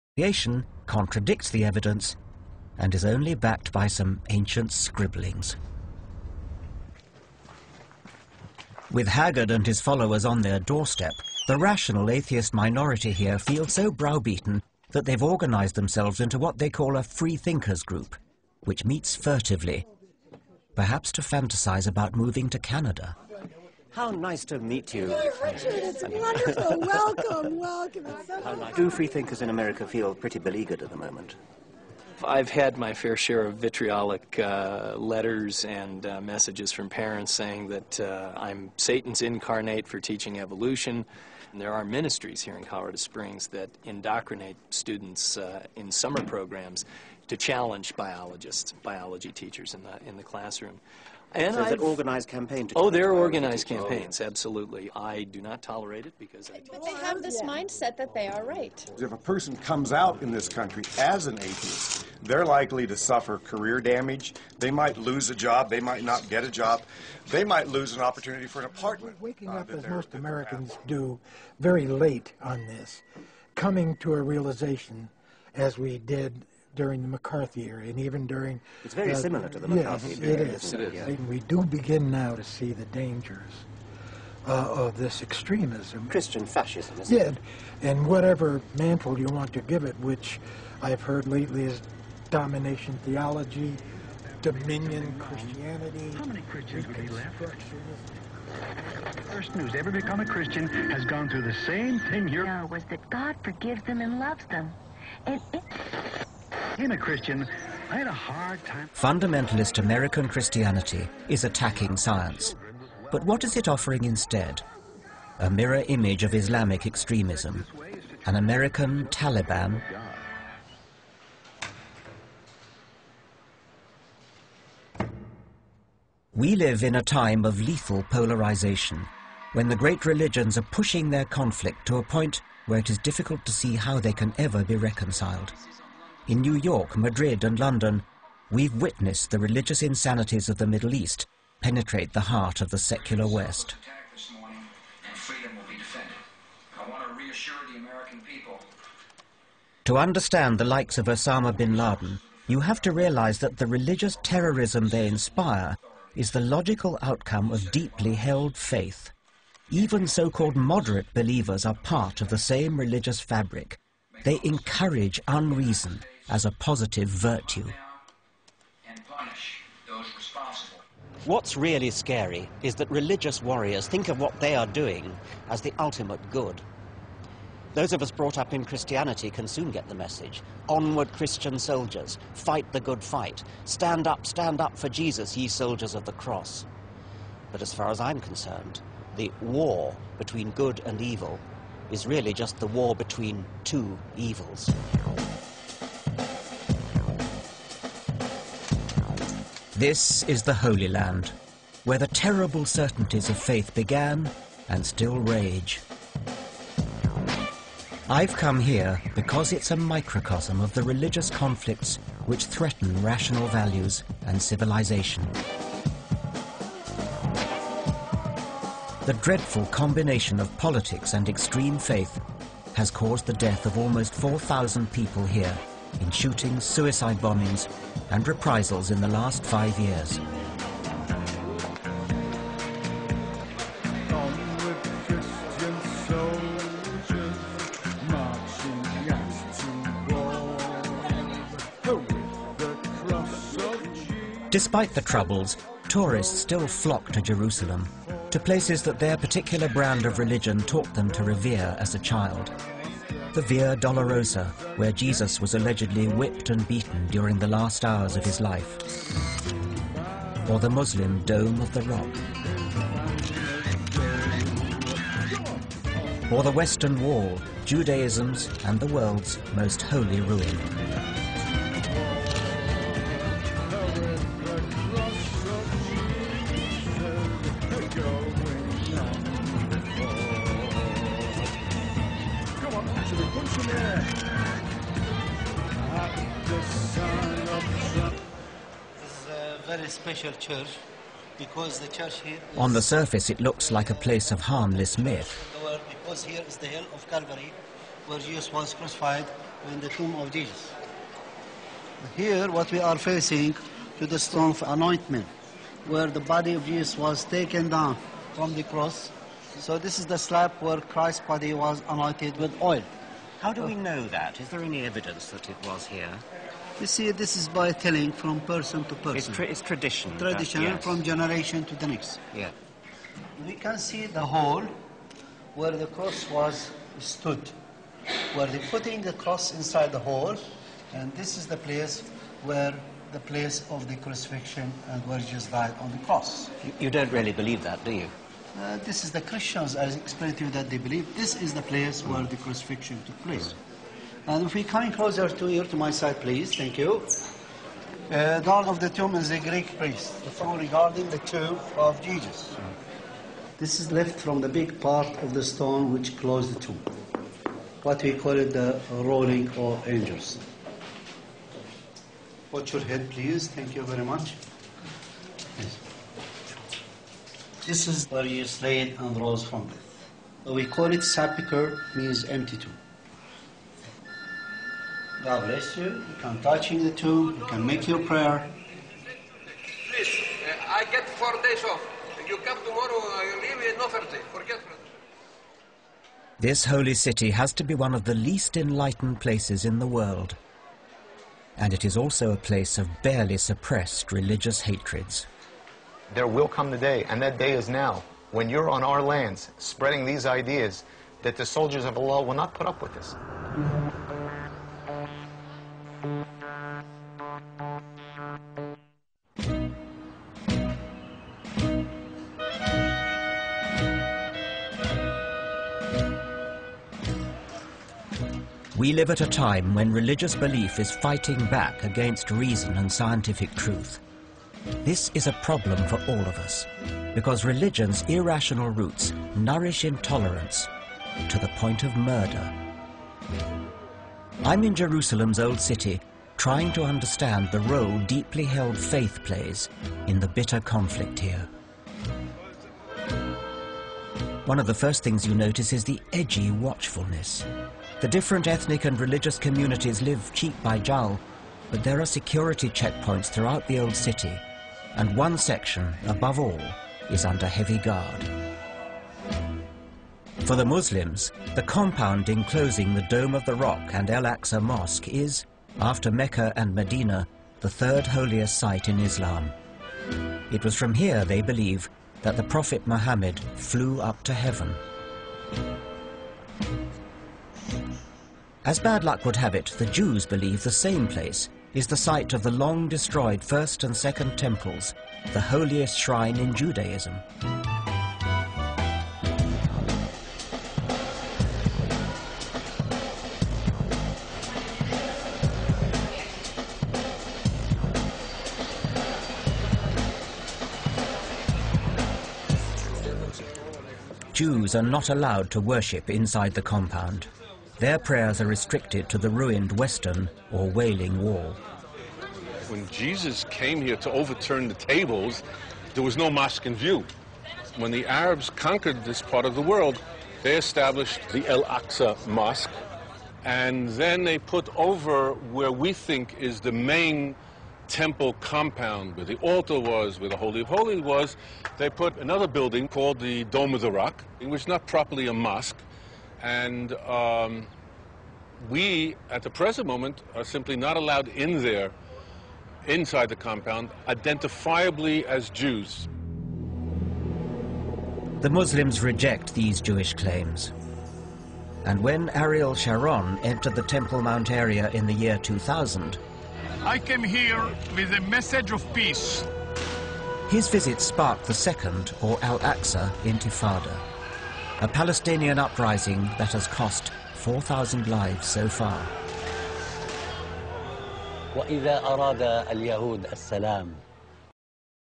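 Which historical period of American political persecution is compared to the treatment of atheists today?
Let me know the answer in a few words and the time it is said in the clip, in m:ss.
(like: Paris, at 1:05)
McCarthy era, at 1:17.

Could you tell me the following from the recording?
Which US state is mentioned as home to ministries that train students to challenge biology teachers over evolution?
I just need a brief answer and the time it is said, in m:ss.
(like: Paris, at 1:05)
Colorado, at 0:42.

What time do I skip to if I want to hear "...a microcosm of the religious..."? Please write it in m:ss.
3:29.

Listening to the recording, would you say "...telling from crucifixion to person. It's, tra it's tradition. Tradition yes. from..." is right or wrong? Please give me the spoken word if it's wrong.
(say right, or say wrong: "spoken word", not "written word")
wrong: "person", not "crucifixion".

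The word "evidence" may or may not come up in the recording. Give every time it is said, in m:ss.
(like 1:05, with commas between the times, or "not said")
0:01, 5:14.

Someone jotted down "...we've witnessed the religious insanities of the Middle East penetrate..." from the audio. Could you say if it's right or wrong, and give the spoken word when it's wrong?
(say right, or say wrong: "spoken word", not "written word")
right.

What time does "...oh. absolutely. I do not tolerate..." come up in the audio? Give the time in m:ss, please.
0:54.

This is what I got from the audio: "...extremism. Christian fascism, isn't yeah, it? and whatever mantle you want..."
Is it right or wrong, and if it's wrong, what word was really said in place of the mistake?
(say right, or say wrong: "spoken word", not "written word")
right.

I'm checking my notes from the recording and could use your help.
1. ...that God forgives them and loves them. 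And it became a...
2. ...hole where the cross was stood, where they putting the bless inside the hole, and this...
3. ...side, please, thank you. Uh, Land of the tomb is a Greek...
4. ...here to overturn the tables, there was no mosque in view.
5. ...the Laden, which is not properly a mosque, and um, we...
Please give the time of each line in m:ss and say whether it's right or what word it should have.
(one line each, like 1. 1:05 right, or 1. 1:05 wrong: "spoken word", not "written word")
1. 1:42 right
2. 5:24 wrong: "cross", not "bless"
3. 5:45 wrong: "God", not "Land"
4. 8:33 right
5. 8:53 wrong: "Rock", not "Laden".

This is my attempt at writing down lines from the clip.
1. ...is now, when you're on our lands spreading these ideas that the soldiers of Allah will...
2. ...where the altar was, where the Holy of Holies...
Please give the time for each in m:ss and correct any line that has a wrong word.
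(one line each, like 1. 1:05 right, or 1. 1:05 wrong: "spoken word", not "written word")
1. 6:37 right
2. 8:49 right.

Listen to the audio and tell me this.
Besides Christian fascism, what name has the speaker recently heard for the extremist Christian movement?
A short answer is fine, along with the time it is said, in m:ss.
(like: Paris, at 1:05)
Domination theology, at 1:32.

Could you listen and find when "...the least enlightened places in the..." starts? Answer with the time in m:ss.
6:28.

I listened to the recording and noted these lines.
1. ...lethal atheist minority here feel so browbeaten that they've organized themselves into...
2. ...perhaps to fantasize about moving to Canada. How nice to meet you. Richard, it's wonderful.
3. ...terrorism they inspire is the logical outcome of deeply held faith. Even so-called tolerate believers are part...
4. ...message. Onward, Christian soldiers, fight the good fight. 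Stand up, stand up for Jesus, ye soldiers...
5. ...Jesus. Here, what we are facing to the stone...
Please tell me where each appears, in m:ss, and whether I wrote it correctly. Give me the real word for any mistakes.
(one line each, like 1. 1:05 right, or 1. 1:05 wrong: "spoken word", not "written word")
1. 0:11 wrong: "rational", not "lethal"
2. 0:20 right
3. 2:34 wrong: "moderate", not "tolerate"
4. 2:59 right
5. 5:00 right.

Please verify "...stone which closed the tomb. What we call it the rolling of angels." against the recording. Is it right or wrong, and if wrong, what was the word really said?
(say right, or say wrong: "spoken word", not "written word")
right.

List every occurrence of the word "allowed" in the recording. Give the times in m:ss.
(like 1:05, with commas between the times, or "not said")
8:25, 9:00.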